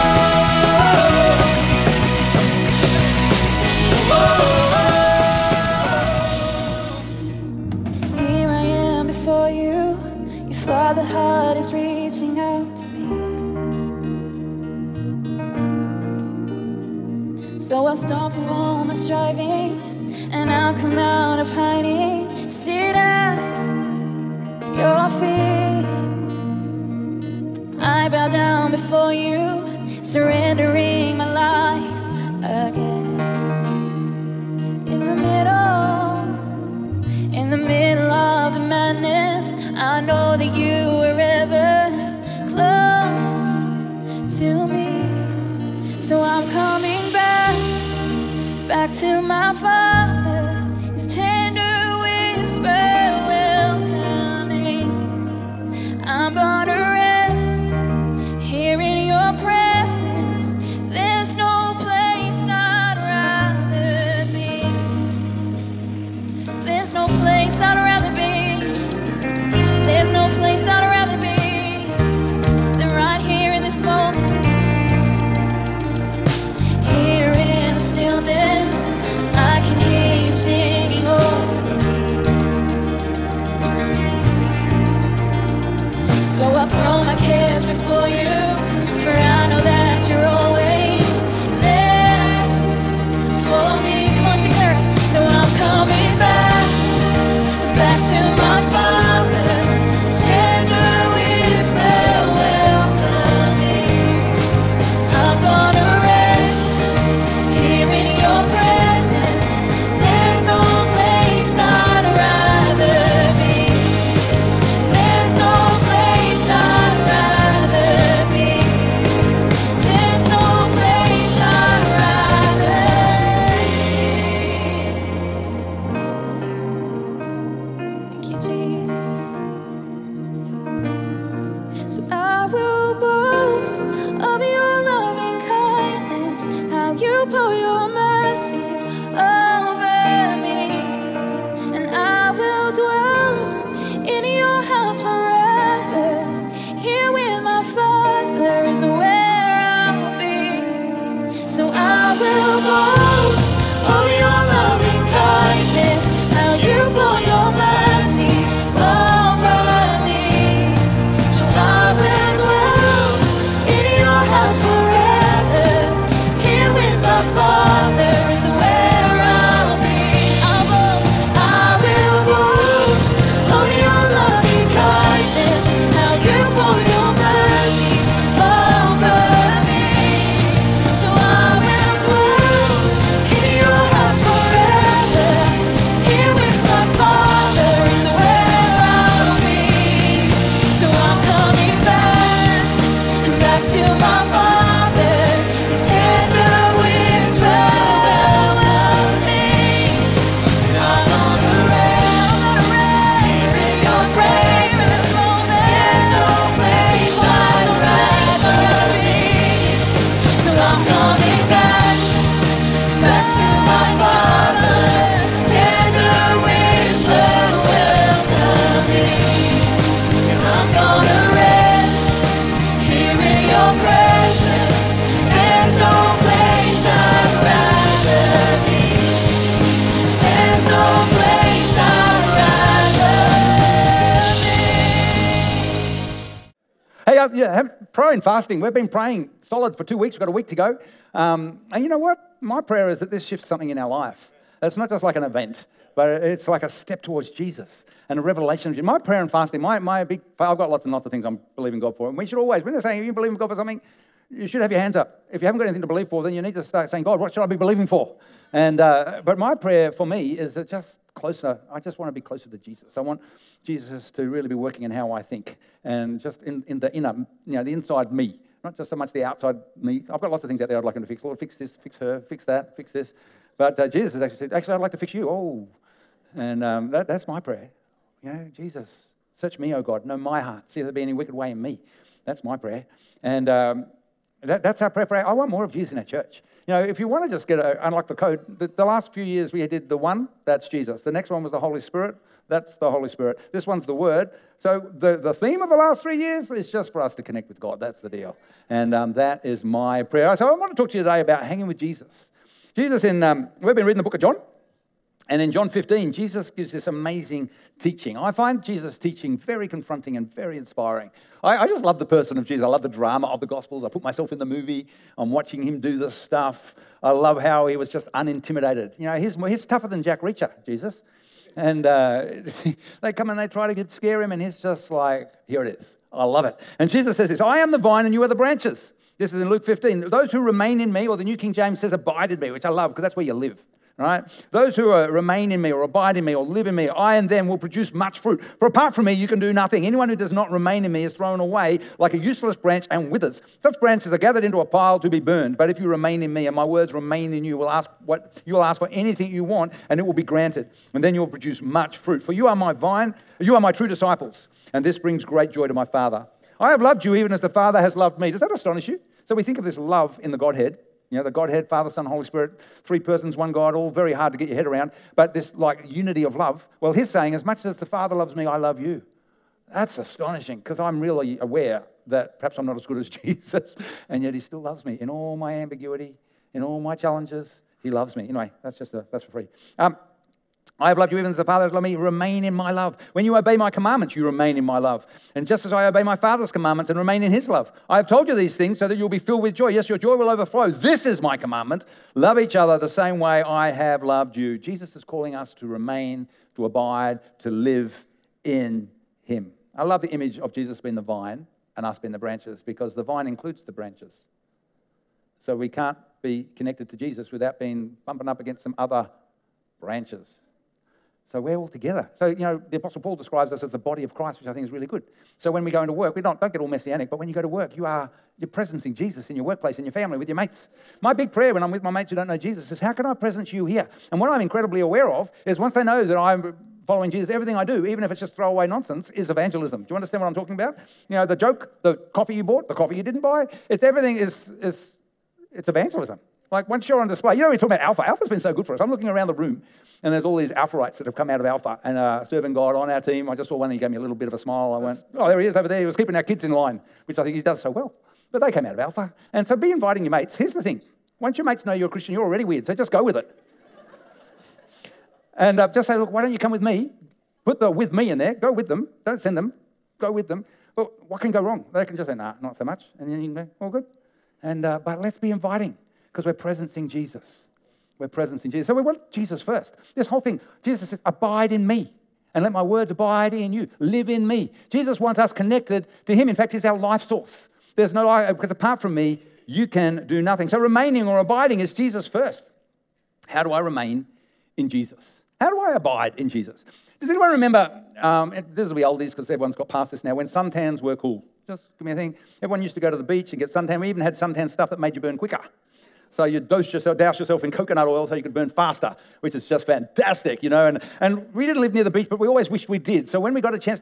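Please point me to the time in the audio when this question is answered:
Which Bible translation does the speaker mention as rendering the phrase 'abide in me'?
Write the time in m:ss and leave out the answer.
5:31.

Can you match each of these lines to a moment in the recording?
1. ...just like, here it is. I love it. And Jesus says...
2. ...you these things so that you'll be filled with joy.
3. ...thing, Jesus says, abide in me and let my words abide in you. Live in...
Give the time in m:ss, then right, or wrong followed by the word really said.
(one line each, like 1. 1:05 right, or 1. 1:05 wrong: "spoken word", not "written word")
1. 5:24 right
2. 6:28 right
3. 7:50 right.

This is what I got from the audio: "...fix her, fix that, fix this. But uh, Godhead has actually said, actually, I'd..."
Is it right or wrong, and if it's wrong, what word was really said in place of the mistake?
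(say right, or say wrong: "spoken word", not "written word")
wrong: "Jesus", not "Godhead".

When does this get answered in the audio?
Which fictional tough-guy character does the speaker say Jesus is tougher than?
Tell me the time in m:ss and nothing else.
5:20.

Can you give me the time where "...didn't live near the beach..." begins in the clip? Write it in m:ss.
8:21.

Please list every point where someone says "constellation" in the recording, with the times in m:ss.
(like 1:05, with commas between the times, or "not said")
not said.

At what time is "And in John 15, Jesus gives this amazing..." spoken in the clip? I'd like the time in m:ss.
5:05.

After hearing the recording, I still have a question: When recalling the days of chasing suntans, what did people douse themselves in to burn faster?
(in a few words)
coconut oil.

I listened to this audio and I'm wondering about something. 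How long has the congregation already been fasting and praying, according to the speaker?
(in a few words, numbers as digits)
2 weeks.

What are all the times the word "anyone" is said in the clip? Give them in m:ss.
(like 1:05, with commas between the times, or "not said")
5:39, 8:07.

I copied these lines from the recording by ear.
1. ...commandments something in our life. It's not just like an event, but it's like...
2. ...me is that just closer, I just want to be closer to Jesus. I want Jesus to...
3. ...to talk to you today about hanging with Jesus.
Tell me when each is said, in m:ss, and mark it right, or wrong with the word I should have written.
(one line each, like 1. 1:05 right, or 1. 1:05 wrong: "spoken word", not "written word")
1. 4:03 wrong: "shifts", not "commandments"
2. 4:20 right
3. 5:00 right.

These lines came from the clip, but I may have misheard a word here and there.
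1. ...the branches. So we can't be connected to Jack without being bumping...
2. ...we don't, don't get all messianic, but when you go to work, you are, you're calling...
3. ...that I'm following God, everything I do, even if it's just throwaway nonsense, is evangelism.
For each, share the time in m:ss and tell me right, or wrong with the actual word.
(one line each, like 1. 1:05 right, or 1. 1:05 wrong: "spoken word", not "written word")
1. 6:43 wrong: "Jesus", not "Jack"
2. 6:56 wrong: "presencing", not "calling"
3. 7:06 wrong: "Jesus", not "God".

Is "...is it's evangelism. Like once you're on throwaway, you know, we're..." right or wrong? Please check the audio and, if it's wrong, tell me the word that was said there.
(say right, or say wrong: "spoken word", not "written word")
wrong: "display", not "throwaway".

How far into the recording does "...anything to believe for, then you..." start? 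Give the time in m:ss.
4:15.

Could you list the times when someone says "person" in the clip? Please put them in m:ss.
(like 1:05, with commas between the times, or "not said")
5:12, 6:02.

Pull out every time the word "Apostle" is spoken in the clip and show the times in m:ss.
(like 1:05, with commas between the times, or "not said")
6:52.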